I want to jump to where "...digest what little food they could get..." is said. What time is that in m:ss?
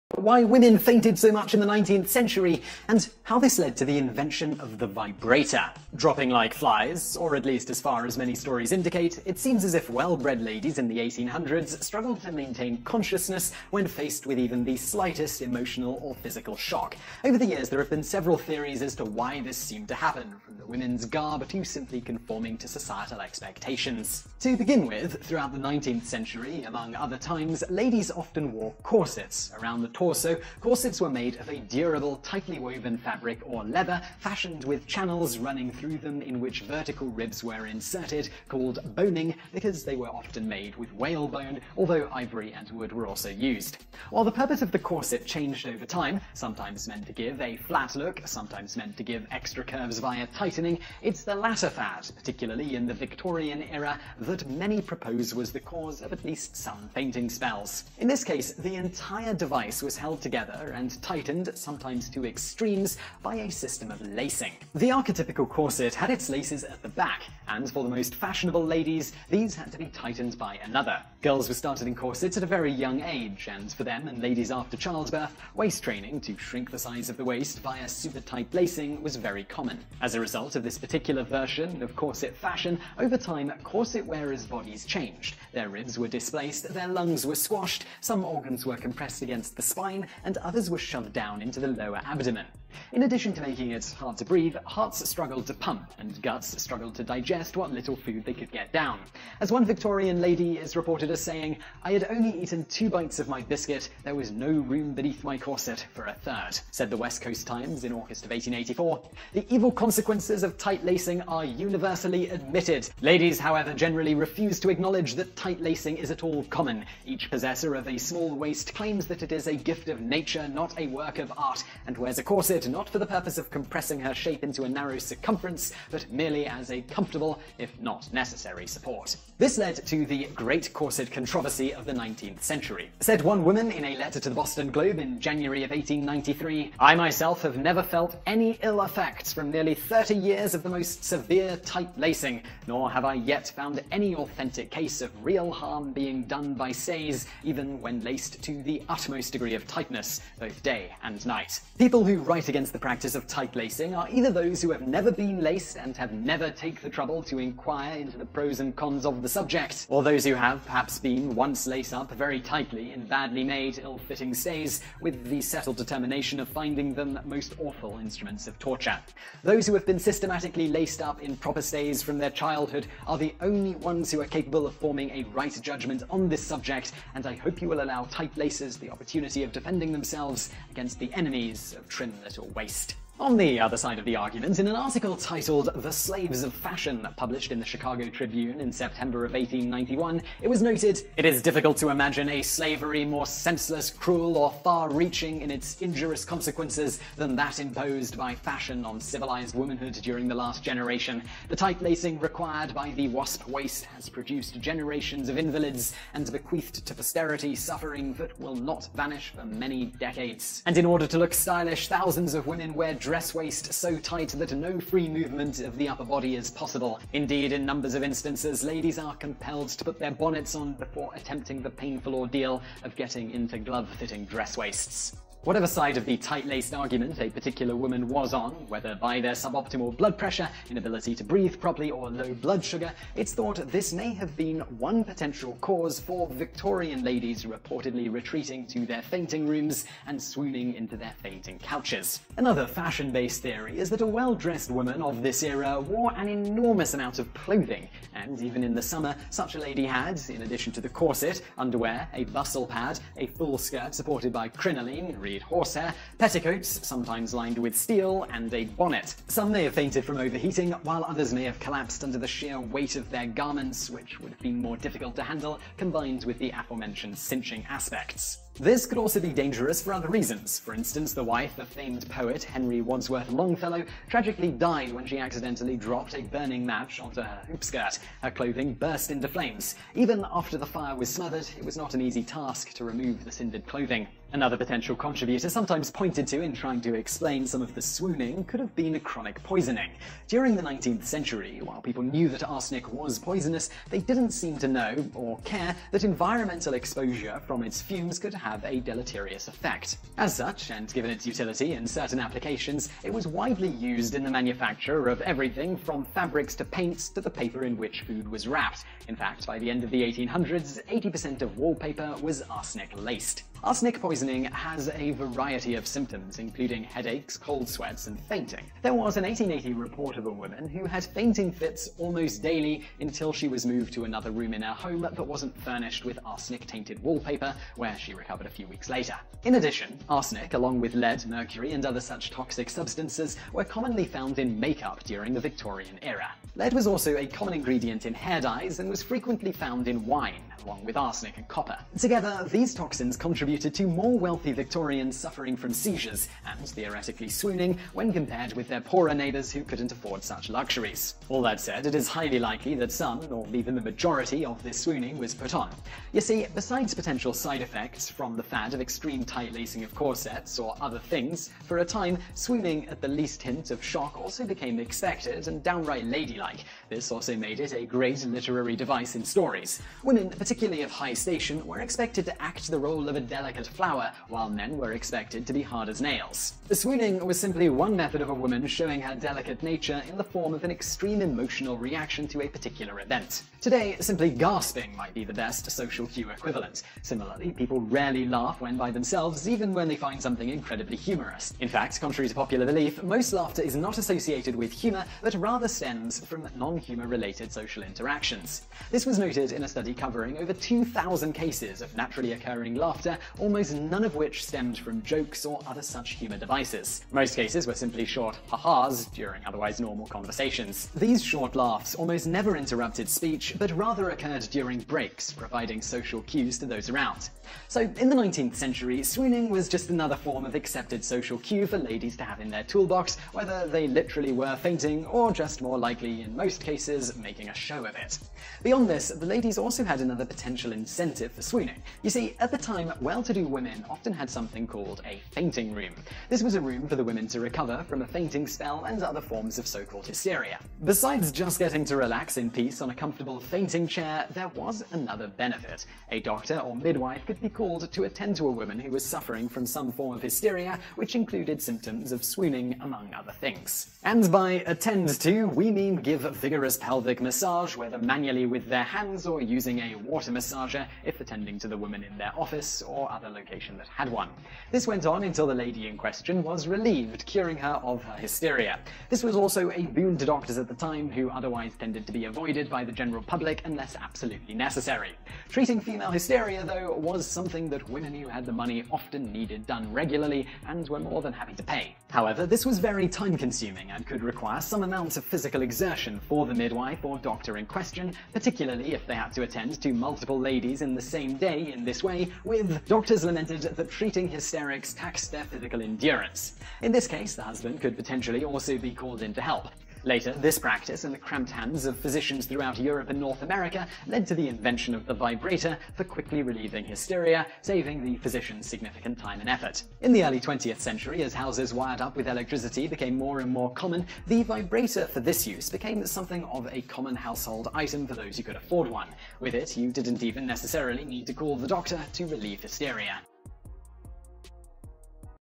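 1:37.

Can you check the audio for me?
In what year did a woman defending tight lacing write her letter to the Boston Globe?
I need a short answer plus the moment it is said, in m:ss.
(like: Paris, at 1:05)
1893, at 2:15.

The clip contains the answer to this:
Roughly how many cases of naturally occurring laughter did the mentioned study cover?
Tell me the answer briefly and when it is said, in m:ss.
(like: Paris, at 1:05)
over 2,000, at 6:40.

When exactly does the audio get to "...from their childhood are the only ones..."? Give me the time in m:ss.
2:52.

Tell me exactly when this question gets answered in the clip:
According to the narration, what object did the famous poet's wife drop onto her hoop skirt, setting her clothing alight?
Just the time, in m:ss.
4:36.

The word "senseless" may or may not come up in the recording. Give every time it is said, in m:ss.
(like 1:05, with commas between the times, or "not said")
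3:13.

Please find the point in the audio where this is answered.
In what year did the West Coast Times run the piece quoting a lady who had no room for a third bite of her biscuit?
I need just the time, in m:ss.
1:48.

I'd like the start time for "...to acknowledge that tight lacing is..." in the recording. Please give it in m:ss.
1:54.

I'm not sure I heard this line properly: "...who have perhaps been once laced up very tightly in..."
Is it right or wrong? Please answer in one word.
right.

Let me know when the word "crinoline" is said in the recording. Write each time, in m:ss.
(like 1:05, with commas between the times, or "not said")
4:14.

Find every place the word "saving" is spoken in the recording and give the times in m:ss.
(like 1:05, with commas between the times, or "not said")
8:27.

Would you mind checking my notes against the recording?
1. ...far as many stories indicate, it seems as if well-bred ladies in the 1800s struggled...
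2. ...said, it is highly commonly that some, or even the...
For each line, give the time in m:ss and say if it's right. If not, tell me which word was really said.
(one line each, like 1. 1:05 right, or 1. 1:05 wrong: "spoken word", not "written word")
1. 0:07 right
2. 5:51 wrong: "likely", not "commonly".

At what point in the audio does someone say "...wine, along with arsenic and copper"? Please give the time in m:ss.
5:40.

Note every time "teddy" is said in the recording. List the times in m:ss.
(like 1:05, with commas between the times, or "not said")
not said.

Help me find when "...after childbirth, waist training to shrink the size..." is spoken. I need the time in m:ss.
1:14.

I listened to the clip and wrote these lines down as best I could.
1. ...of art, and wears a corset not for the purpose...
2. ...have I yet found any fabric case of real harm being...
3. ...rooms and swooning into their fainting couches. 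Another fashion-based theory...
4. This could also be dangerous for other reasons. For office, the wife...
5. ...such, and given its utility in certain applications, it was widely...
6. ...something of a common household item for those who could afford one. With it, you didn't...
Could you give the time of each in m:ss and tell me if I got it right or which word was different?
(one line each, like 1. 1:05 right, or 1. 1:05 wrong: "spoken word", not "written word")
1. 2:01 right
2. 2:22 wrong: "authentic", not "fabric"
3. 3:59 right
4. 4:28 wrong: "instance", not "office"
5. 5:00 right
6. 8:36 right.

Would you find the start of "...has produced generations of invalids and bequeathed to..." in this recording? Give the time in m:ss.
3:23.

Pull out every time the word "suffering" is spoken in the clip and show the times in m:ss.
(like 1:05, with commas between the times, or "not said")
3:27, 5:45, 7:29.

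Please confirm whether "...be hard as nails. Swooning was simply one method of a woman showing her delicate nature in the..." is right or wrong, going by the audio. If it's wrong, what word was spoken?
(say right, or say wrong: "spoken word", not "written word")
right.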